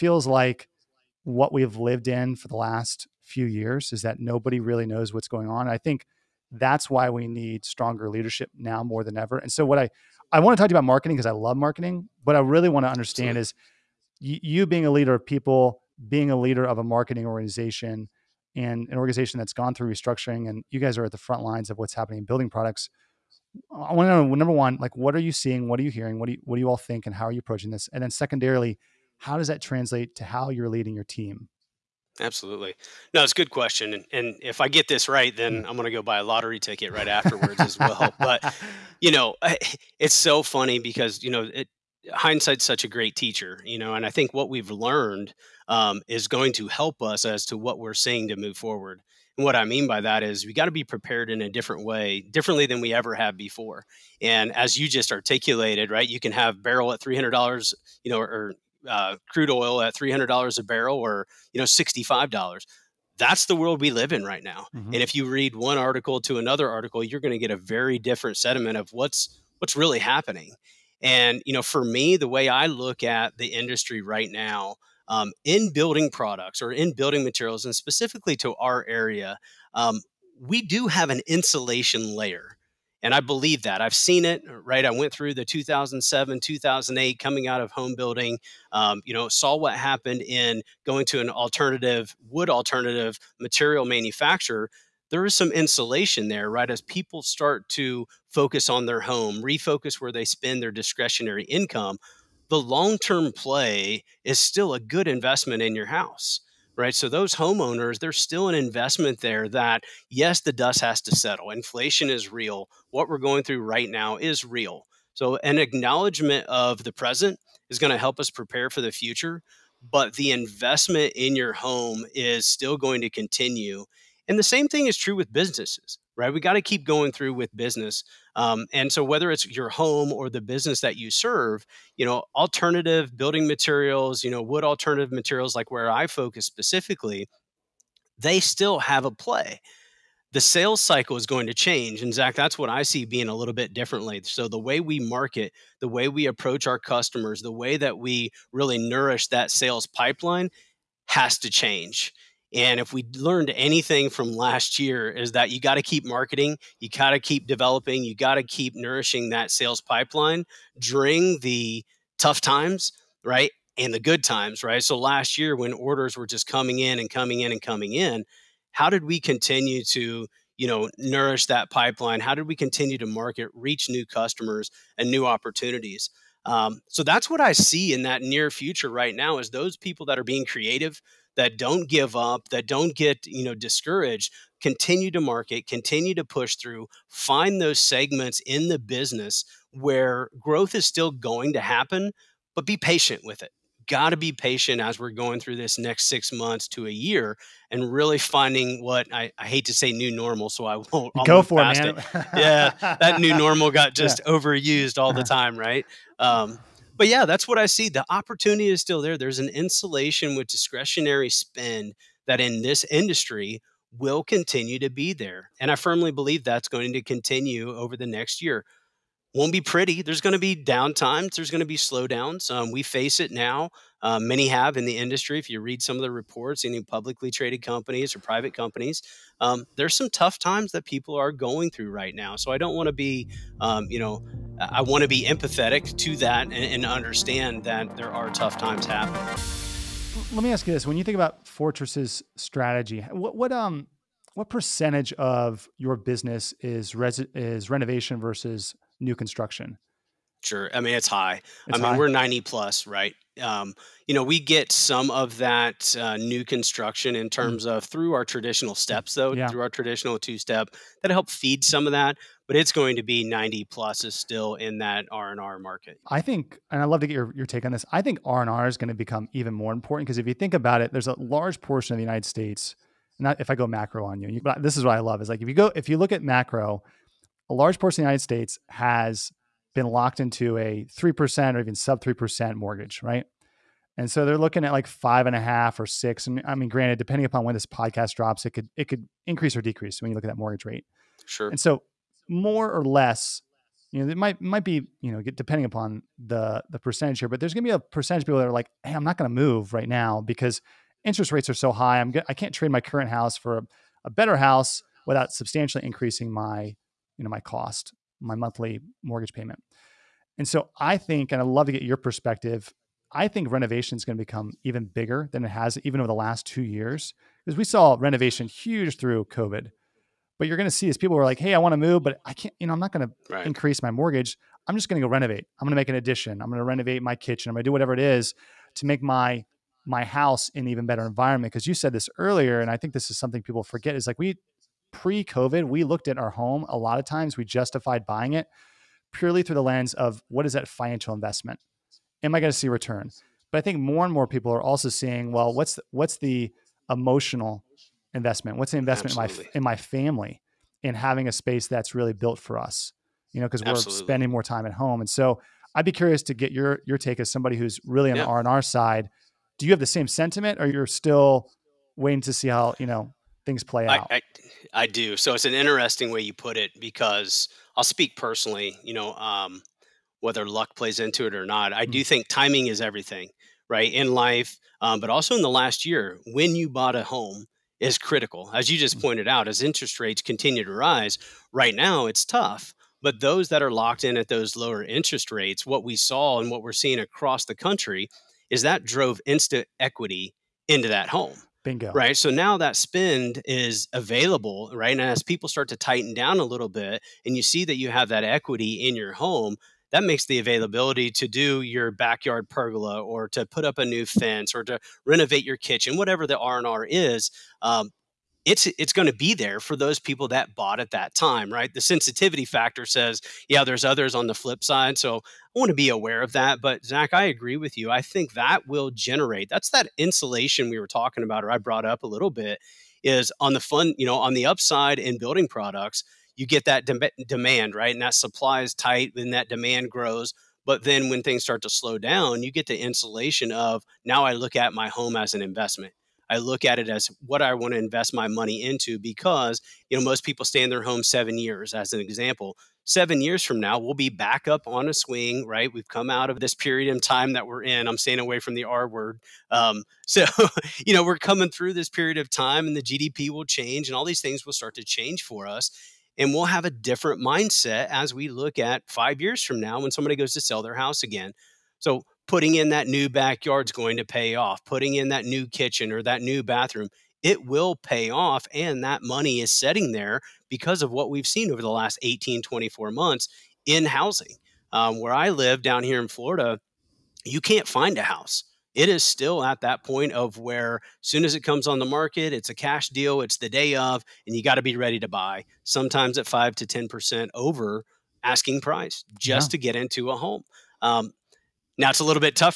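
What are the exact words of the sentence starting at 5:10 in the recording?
And so I think, and I'd love to get your perspective.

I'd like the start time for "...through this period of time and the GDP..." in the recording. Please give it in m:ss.
7:31.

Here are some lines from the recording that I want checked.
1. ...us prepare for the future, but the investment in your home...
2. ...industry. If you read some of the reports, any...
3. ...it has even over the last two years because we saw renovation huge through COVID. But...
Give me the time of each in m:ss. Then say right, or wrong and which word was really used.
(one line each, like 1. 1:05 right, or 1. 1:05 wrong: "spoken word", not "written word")
1. 1:58 right
2. 3:44 right
3. 5:15 right.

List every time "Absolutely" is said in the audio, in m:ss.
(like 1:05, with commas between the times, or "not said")
0:13, 0:32, 5:53.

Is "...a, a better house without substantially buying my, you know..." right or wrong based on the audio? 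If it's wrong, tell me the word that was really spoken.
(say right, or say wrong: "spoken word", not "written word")
wrong: "increasing", not "buying".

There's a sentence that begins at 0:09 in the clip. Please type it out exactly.
And so what I I want to talk to you about marketing because I love marketing.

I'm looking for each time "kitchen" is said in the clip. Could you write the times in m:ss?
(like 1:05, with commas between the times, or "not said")
5:27, 6:45, 7:45.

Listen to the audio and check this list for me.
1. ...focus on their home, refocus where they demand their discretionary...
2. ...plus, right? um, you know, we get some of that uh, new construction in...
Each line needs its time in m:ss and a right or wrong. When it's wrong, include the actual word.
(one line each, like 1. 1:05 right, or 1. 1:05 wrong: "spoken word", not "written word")
1. 1:38 wrong: "spend", not "demand"
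2. 4:12 right.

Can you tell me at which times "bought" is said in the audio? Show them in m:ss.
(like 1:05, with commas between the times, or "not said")
6:16, 6:50.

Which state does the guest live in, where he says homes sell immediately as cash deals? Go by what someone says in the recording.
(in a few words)
Florida.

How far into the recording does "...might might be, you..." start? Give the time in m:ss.
4:54.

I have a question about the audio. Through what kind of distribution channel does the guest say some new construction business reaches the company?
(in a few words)
two step.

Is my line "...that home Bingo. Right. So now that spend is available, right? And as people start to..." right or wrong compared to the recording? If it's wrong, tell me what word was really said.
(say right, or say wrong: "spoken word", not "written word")
right.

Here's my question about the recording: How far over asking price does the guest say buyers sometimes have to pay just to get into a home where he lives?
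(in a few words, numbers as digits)
5 to 10%.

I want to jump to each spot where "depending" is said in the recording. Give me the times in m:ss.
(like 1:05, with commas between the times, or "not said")
4:46, 4:55.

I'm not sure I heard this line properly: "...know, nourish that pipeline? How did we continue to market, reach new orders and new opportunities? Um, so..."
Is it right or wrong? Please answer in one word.
wrong.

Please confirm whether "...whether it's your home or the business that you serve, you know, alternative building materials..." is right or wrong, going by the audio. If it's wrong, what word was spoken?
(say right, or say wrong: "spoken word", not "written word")
right.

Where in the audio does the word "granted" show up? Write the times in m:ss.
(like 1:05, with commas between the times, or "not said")
4:46.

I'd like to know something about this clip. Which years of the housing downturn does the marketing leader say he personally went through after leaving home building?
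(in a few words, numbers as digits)
2007, 2008.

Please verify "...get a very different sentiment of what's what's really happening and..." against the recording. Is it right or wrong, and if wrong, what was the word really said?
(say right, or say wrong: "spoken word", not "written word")
right.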